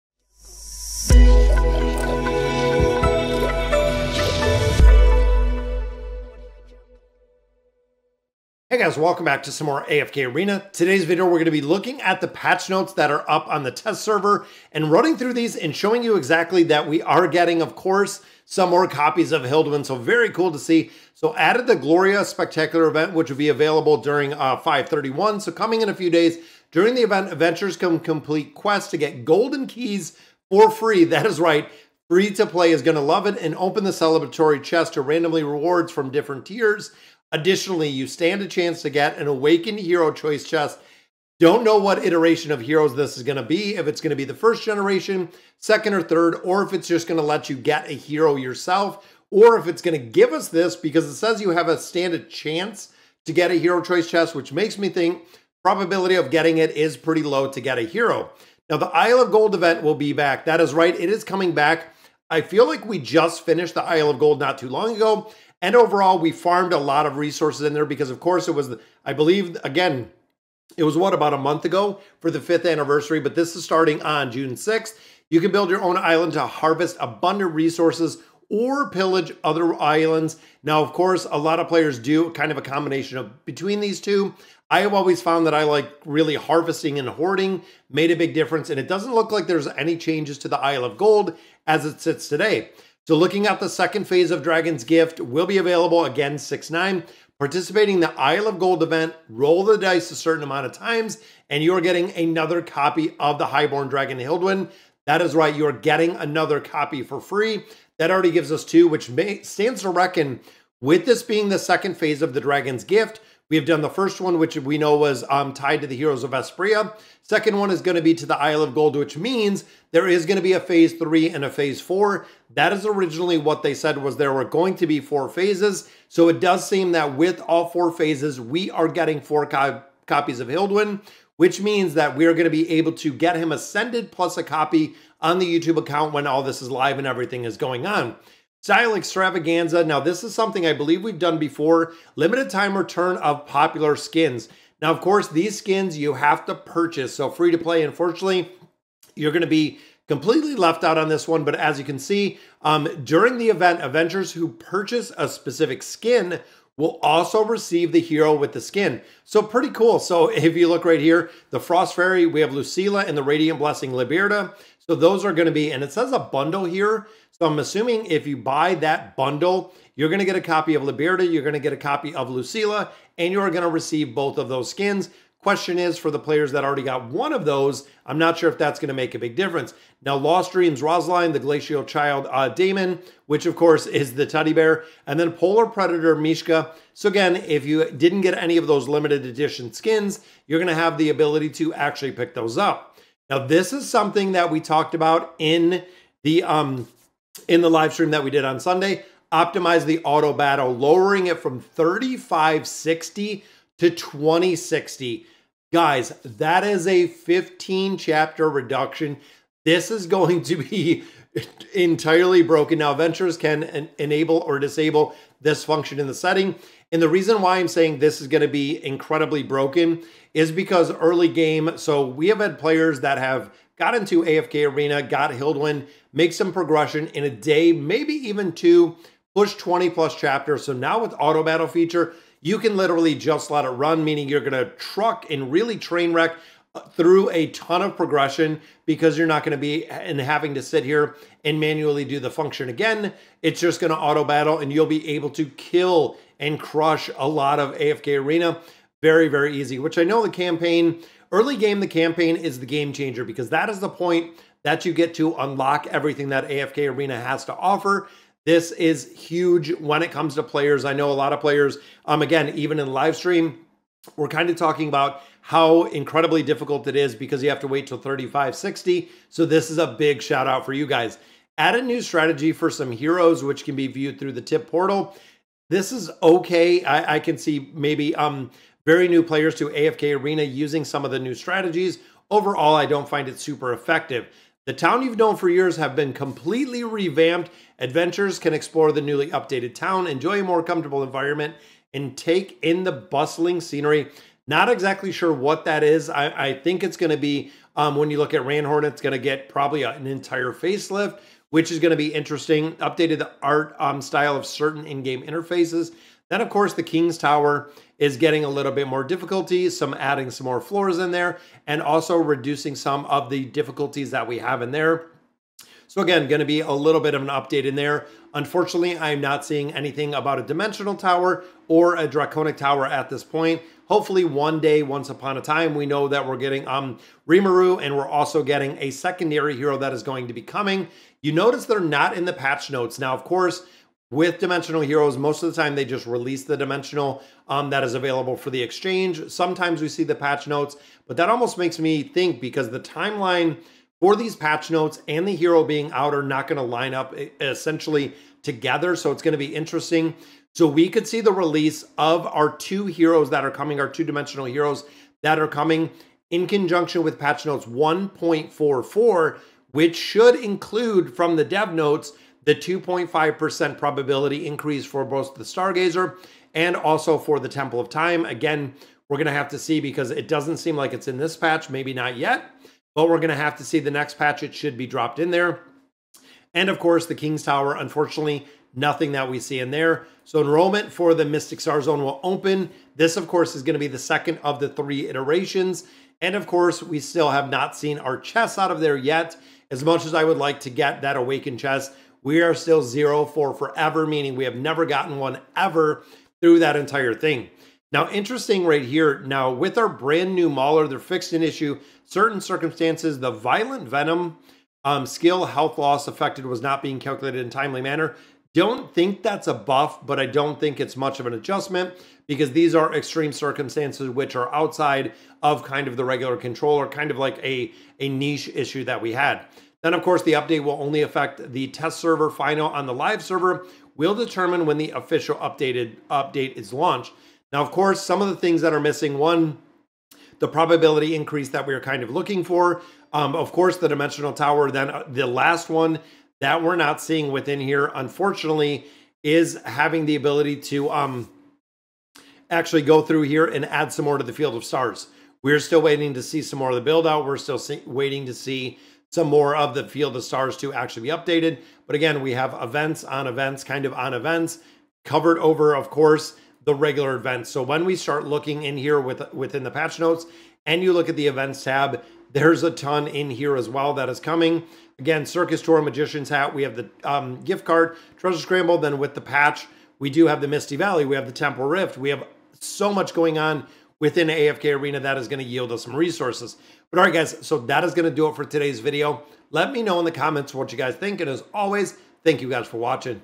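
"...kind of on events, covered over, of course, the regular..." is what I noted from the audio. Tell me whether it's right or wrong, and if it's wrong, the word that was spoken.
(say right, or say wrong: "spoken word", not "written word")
right.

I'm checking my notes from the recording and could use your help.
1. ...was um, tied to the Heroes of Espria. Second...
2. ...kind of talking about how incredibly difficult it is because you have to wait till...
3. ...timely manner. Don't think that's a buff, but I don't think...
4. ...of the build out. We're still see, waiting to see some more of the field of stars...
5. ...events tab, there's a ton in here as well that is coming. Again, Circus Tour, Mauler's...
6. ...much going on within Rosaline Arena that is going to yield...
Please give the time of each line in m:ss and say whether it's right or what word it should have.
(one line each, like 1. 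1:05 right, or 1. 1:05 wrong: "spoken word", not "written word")
1. 1:54 right
2. 4:24 right
3. 6:47 right
4. 7:26 right
5. 7:41 wrong: "Magician", not "Mauler"
6. 7:52 wrong: "AFK", not "Rosaline".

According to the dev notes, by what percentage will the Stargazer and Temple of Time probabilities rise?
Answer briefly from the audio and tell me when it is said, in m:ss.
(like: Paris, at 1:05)
2.5%, at 6:02.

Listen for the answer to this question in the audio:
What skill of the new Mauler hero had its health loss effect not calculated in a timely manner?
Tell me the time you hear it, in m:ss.
6:43.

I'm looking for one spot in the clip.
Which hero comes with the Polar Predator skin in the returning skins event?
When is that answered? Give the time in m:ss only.
3:06.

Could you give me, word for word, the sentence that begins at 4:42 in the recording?
Overall, I don't find it super effective.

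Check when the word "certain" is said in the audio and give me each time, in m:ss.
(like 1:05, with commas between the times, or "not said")
1:40, 5:04, 6:42.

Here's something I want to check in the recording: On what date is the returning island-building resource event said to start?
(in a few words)
June 6th.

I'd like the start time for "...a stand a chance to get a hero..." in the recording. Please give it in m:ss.
0:51.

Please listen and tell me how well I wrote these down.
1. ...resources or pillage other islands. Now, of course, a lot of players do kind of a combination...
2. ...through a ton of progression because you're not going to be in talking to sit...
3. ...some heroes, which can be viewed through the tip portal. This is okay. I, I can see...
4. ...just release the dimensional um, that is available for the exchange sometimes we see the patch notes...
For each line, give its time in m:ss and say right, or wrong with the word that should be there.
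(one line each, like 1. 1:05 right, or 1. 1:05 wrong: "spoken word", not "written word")
1. 1:17 right
2. 3:56 wrong: "having", not "talking"
3. 4:32 right
4. 5:35 right.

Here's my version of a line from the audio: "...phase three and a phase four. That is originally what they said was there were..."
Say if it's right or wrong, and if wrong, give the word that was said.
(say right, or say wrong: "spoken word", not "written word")
right.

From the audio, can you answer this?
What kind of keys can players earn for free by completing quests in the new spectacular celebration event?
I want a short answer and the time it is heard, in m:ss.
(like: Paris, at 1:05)
Golden keys, at 0:29.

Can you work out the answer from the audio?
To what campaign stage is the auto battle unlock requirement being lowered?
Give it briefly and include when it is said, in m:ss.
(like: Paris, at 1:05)
20-60, at 3:23.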